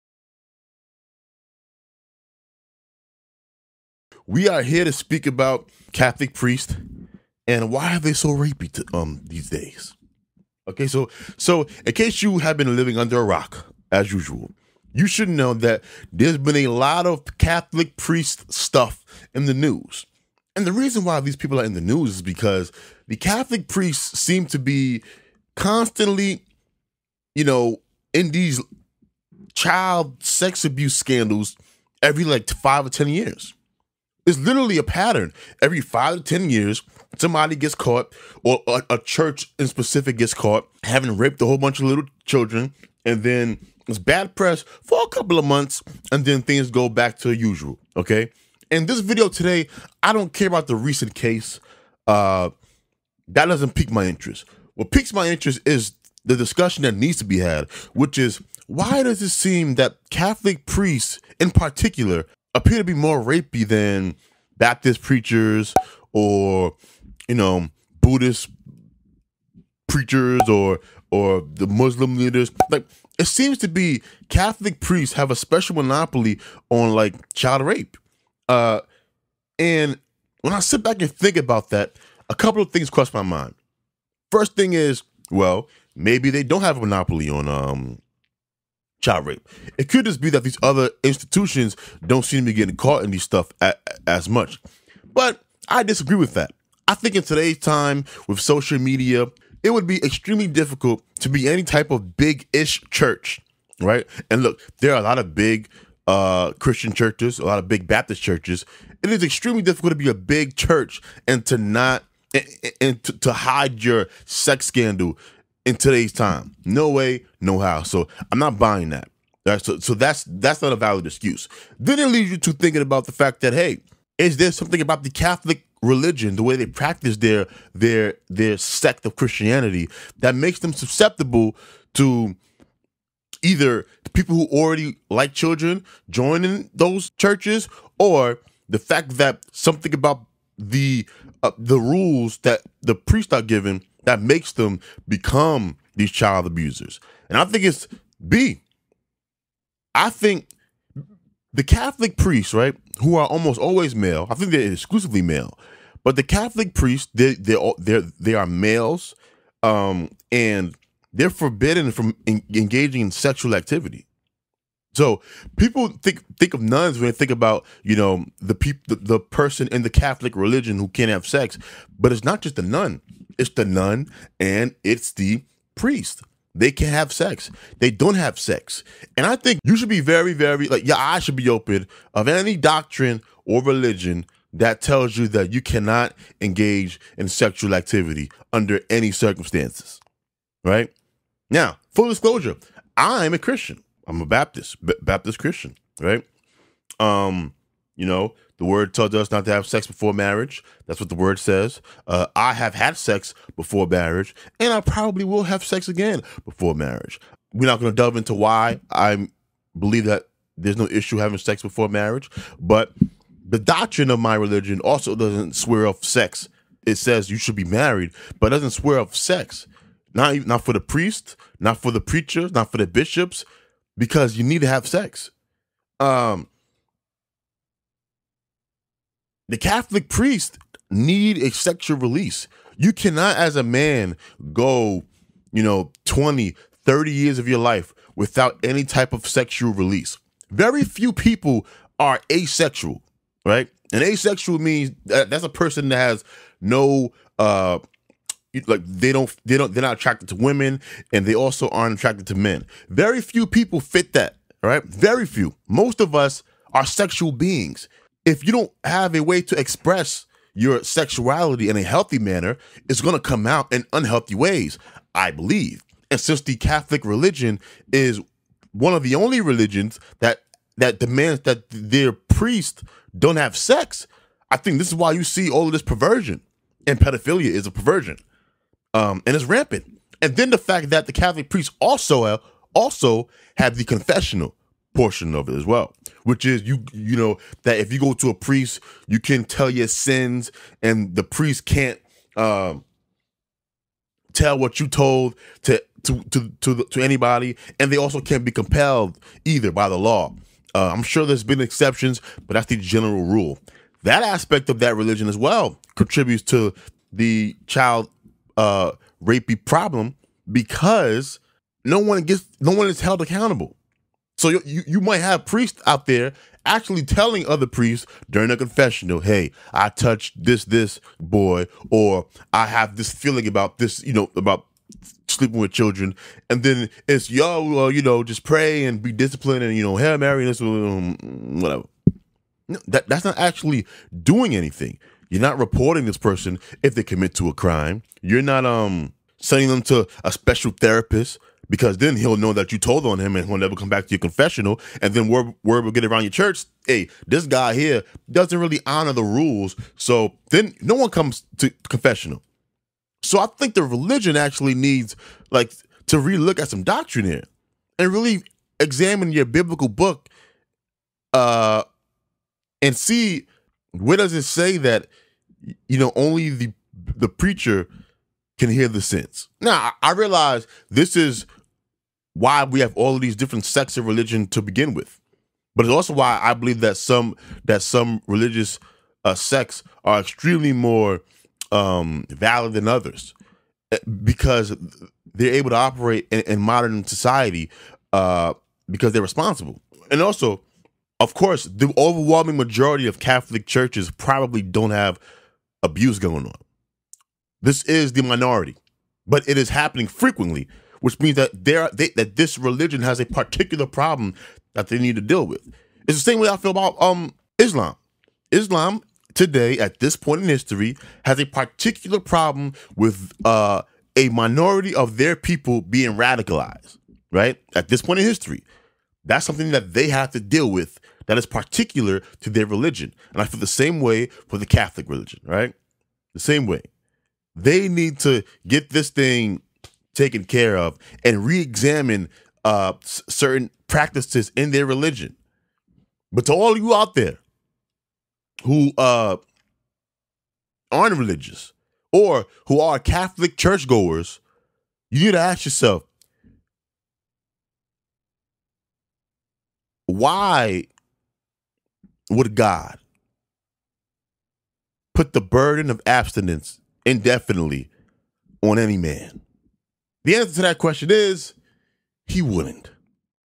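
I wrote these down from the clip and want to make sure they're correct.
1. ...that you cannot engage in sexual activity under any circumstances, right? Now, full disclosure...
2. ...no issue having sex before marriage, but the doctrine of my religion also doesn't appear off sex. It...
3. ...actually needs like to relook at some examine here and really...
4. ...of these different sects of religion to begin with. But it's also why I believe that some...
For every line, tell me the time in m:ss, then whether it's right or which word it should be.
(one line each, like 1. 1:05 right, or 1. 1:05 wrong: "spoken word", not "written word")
1. 3:05 right
2. 3:30 wrong: "swear", not "appear"
3. 5:54 wrong: "doctrine", not "examine"
4. 6:13 right.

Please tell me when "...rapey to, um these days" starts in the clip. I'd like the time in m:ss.
0:08.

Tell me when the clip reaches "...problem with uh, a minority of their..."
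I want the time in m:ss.
6:52.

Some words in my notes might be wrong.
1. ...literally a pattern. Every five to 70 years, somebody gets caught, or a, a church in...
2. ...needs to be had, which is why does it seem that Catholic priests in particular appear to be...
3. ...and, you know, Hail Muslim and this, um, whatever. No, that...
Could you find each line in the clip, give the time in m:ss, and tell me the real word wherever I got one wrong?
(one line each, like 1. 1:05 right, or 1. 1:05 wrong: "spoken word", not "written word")
1. 0:34 wrong: "10", not "70"
2. 0:56 right
3. 5:29 wrong: "Mary", not "Muslim".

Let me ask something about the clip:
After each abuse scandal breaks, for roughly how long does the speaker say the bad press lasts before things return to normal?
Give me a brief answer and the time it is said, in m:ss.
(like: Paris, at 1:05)
a couple of months, at 0:45.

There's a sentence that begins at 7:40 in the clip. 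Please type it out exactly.
The answer to that question is he wouldn't.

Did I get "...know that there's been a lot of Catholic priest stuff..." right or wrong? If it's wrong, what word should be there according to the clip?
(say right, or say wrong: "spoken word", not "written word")
right.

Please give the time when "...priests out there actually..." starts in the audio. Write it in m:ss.
5:15.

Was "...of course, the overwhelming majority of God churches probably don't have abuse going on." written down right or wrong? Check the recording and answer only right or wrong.
wrong.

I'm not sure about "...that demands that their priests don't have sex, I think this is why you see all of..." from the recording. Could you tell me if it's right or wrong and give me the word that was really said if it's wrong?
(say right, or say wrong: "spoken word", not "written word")
right.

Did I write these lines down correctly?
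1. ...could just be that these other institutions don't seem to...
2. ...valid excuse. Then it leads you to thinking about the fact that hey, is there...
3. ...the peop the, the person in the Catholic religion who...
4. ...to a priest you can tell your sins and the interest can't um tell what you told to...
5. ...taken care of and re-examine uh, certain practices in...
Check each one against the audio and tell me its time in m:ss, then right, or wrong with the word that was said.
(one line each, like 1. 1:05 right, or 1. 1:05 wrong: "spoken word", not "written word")
1. 1:29 right
2. 2:00 right
3. 2:48 right
4. 4:48 wrong: "priest", not "interest"
5. 7:10 right.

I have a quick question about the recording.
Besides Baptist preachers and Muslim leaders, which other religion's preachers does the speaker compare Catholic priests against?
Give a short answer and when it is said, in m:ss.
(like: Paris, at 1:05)
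Buddhist, at 1:08.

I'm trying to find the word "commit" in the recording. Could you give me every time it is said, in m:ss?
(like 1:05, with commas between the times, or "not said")
5:37.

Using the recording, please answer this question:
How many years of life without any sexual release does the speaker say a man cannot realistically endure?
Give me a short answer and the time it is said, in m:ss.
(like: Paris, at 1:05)
20, 30 years, at 3:56.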